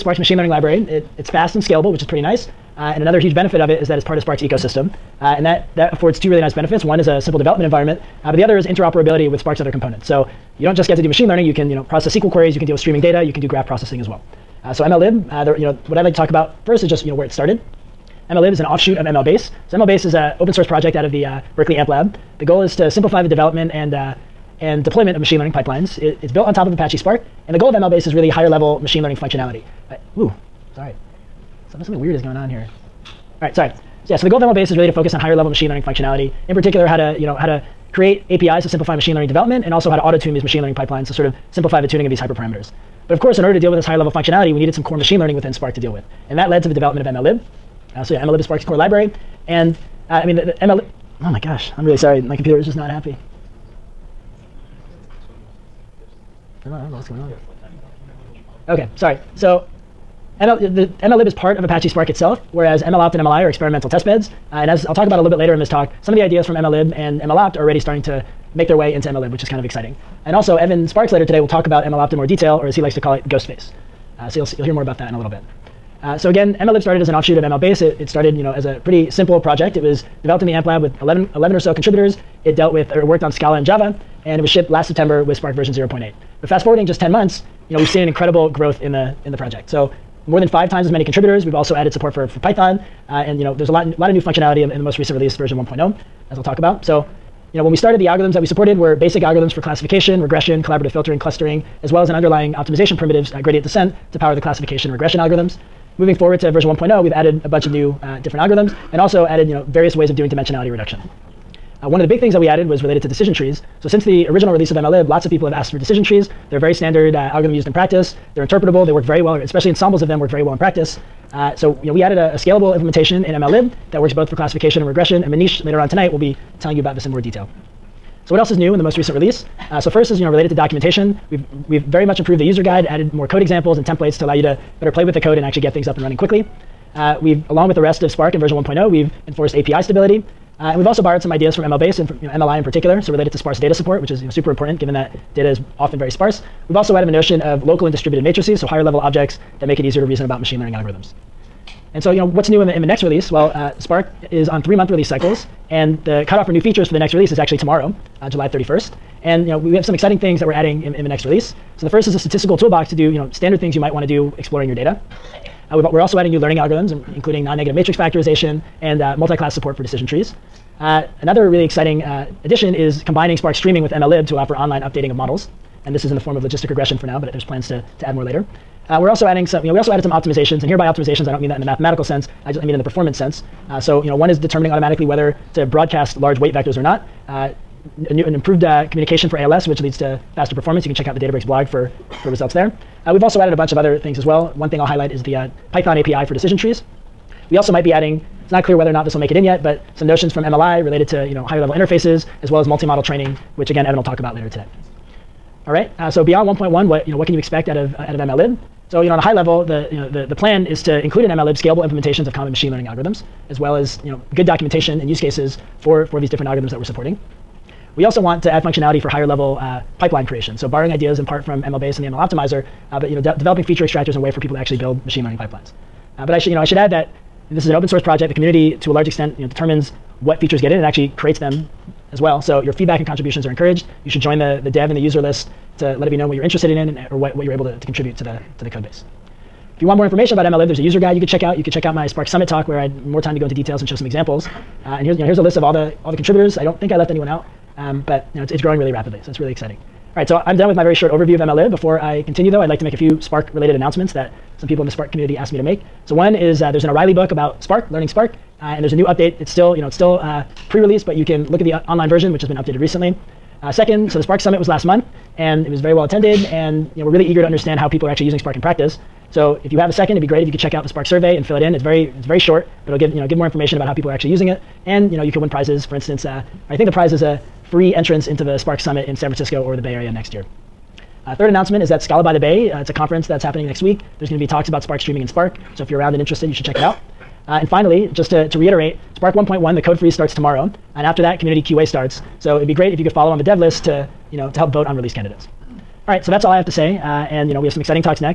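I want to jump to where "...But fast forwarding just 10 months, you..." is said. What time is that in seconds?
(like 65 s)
86 s.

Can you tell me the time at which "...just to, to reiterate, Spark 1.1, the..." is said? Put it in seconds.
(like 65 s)
288 s.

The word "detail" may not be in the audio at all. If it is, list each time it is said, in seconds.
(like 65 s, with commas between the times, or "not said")
72 s, 127 s, 243 s.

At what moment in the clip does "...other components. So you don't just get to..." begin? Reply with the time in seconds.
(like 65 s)
9 s.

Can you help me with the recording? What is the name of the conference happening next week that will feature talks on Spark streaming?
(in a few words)
Scala by the Bay.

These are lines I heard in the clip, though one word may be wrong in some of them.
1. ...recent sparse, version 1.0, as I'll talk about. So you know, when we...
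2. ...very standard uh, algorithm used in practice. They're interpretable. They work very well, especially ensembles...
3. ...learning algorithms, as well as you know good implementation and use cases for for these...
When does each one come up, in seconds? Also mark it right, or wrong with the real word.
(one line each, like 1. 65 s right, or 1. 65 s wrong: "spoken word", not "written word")
1. 94 s wrong: "release", not "sparse"
2. 116 s right
3. 212 s wrong: "documentation", not "implementation".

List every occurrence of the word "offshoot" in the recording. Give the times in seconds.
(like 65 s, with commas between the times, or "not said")
18 s, 77 s.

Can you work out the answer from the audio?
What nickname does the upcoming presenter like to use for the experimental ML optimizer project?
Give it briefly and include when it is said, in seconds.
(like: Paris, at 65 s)
Ghostface, at 73 s.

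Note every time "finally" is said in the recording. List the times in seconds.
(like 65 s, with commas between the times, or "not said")
287 s.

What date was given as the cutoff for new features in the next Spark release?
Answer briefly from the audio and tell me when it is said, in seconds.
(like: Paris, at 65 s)
July 31st, at 158 s.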